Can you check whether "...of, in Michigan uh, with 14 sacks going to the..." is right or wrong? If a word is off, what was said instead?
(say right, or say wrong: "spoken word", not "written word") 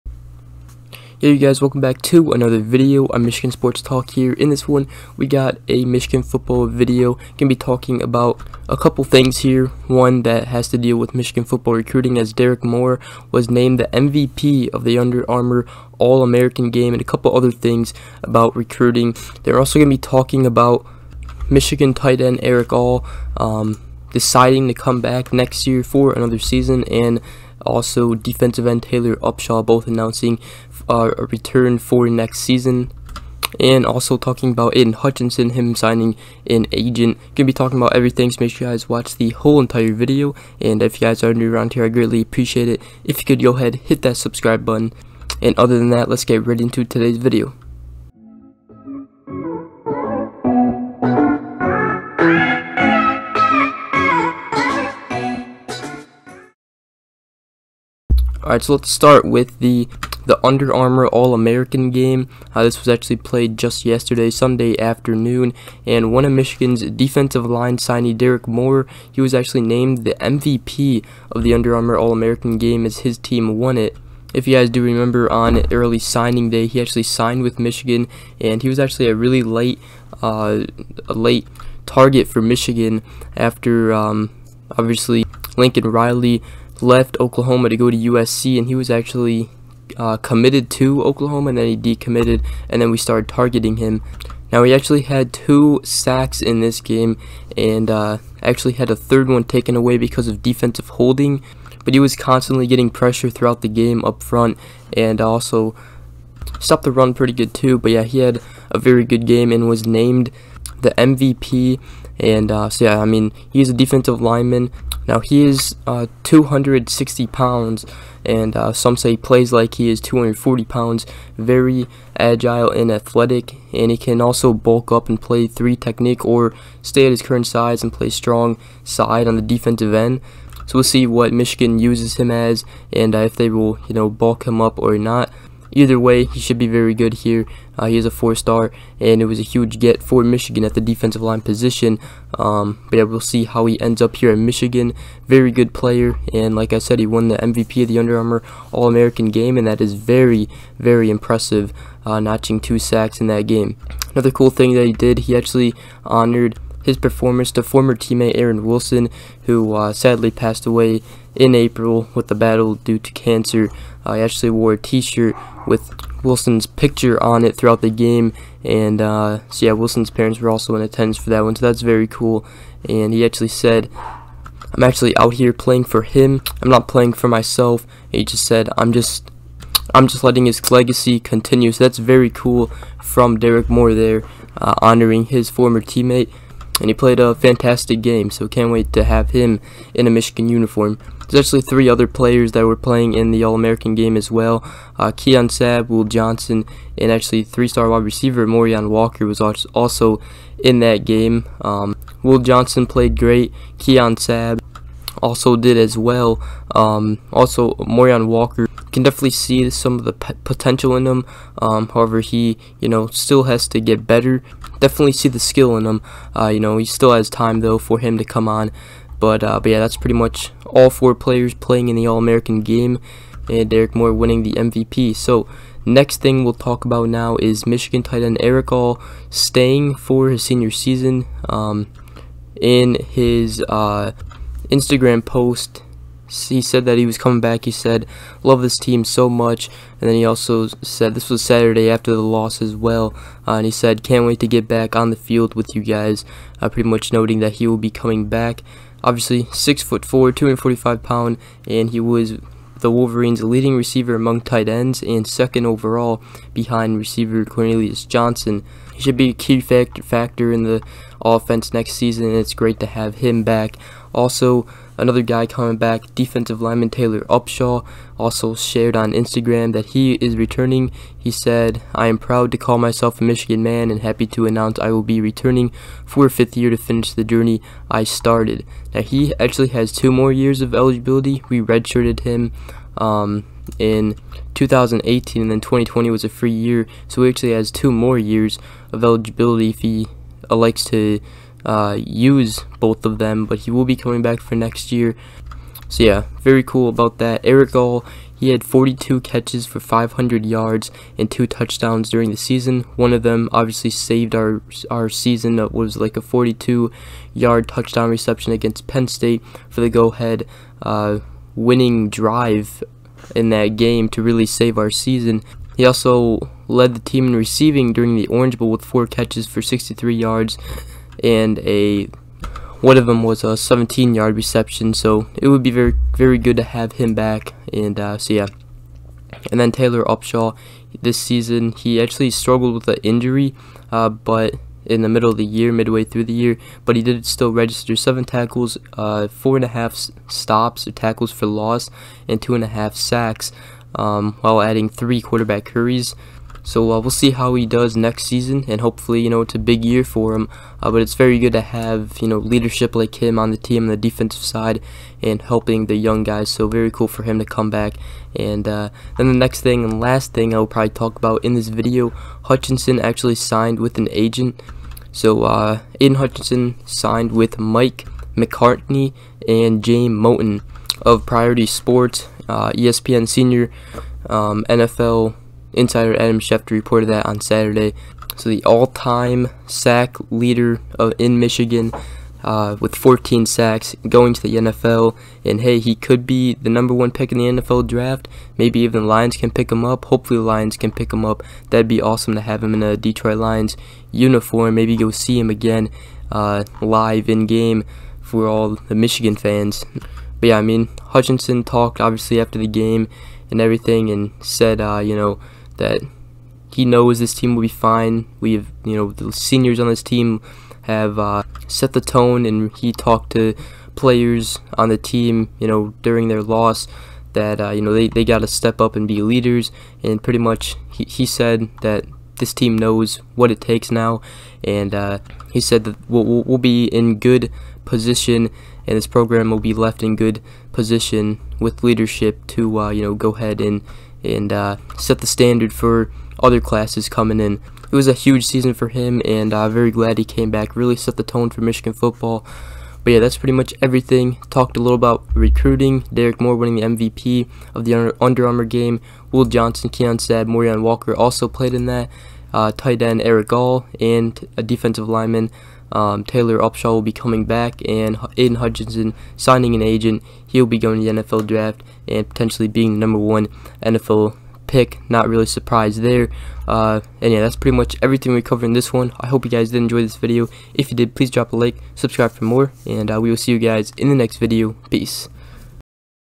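right.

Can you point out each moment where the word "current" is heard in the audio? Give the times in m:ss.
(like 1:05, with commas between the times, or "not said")
2:07.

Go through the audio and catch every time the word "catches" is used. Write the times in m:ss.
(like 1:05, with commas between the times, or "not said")
4:59, 5:19.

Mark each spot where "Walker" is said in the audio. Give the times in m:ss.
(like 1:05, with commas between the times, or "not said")
3:18, 3:28, 7:30.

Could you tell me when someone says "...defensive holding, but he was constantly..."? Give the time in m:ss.
1:40.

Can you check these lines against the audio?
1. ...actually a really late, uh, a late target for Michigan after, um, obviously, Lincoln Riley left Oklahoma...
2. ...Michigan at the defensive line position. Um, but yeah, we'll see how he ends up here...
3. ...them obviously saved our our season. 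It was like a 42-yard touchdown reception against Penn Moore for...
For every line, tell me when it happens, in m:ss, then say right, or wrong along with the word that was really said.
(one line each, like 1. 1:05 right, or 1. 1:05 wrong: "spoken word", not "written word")
1. 1:18 right
2. 2:20 right
3. 5:03 wrong: "State", not "Moore".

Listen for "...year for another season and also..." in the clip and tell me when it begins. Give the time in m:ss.
0:25.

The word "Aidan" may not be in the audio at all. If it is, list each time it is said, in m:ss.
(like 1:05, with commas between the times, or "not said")
0:34, 6:05, 7:38.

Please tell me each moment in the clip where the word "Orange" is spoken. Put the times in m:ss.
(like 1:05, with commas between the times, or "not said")
5:18.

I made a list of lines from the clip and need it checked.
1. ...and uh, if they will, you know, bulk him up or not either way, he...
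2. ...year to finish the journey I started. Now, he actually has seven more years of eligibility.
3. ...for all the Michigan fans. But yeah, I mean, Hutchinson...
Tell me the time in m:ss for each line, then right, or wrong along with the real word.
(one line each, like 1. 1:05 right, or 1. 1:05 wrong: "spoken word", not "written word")
1. 2:12 right
2. 4:36 wrong: "two", not "seven"
3. 6:38 right.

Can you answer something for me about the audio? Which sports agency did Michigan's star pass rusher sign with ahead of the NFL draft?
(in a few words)
Priority Sports.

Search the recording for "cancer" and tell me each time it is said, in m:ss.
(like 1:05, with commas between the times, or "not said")
2:43.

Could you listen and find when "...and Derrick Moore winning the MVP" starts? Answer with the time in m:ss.
3:43.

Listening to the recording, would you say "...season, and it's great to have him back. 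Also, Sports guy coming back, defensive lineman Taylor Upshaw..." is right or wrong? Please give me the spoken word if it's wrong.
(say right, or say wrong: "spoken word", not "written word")
wrong: "Another", not "Sports".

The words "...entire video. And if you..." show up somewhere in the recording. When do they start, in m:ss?
0:39.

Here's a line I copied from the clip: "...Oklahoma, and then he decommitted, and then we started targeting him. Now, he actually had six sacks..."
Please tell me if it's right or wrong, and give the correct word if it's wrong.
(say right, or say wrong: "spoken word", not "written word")
wrong: "two", not "six".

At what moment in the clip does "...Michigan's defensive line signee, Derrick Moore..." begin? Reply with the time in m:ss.
1:06.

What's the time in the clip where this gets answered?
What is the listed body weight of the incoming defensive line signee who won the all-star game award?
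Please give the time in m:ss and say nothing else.
1:56.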